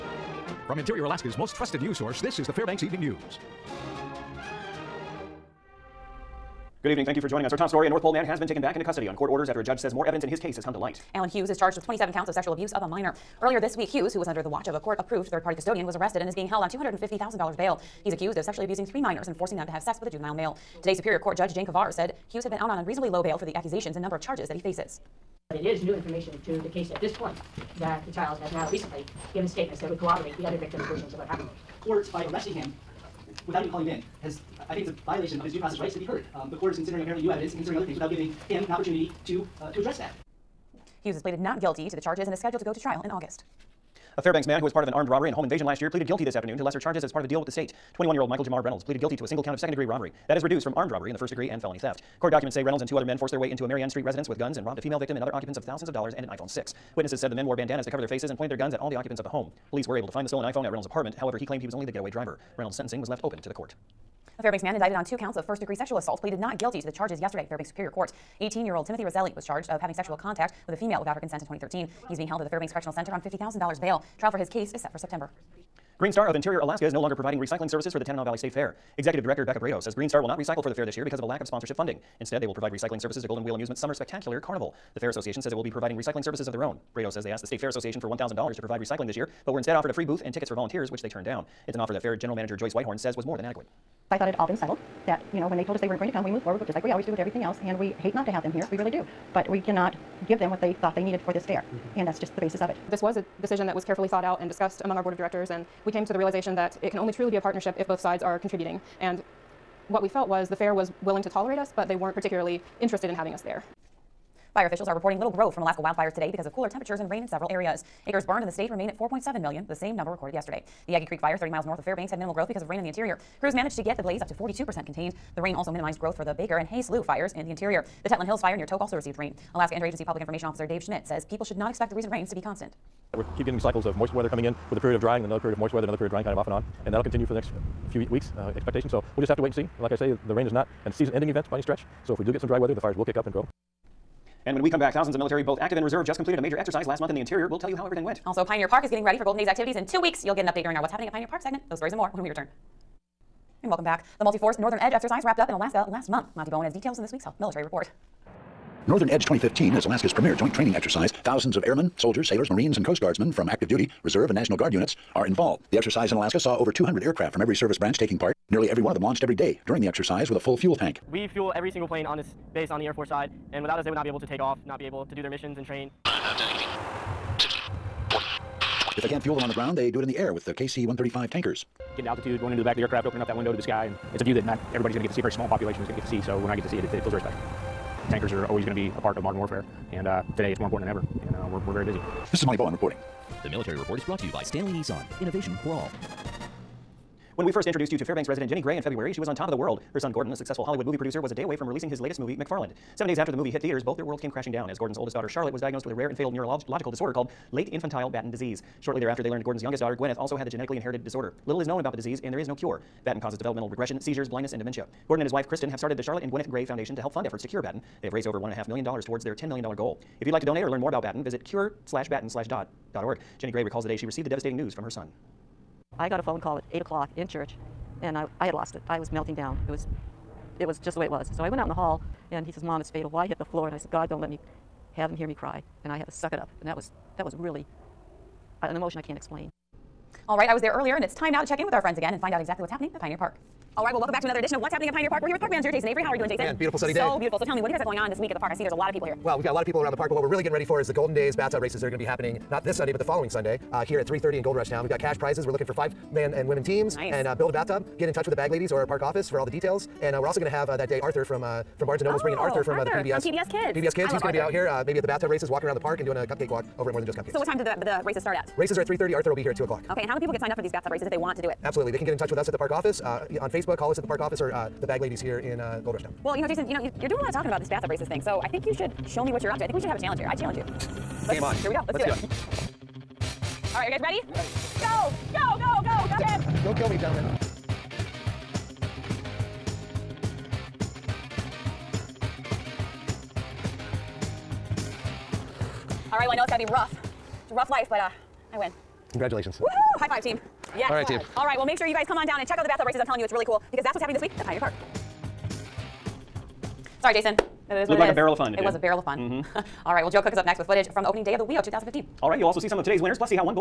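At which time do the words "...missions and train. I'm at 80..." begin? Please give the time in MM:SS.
02:55.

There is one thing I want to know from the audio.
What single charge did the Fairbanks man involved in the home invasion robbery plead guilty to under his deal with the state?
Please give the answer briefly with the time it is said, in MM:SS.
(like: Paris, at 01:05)
Second-degree robbery, at 00:49.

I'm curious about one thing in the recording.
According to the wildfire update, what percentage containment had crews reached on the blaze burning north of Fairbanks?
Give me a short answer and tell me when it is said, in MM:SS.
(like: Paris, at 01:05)
42%, at 02:04.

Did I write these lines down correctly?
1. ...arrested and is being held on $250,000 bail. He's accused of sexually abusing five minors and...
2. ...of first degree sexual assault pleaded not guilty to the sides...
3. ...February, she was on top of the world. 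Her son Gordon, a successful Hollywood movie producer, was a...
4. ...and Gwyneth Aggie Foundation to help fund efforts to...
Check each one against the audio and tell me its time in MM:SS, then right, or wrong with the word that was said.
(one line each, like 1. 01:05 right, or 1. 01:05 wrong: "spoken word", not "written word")
1. 00:15 wrong: "three", not "five"
2. 01:05 wrong: "charges", not "sides"
3. 03:18 right
4. 03:36 wrong: "Gray", not "Aggie".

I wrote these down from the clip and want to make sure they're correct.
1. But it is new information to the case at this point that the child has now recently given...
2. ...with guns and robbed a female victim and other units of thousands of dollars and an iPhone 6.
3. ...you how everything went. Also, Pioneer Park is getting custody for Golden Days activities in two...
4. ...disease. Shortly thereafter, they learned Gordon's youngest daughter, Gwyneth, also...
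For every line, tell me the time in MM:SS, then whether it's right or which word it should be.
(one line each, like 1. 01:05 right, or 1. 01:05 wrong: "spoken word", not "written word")
1. 00:25 right
2. 00:54 wrong: "occupants", not "units"
3. 02:27 wrong: "ready", not "custody"
4. 03:28 right.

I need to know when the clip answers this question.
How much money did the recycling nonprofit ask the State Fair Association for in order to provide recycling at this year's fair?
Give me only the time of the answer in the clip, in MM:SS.
01:28.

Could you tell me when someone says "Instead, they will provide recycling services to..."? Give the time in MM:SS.
01:22.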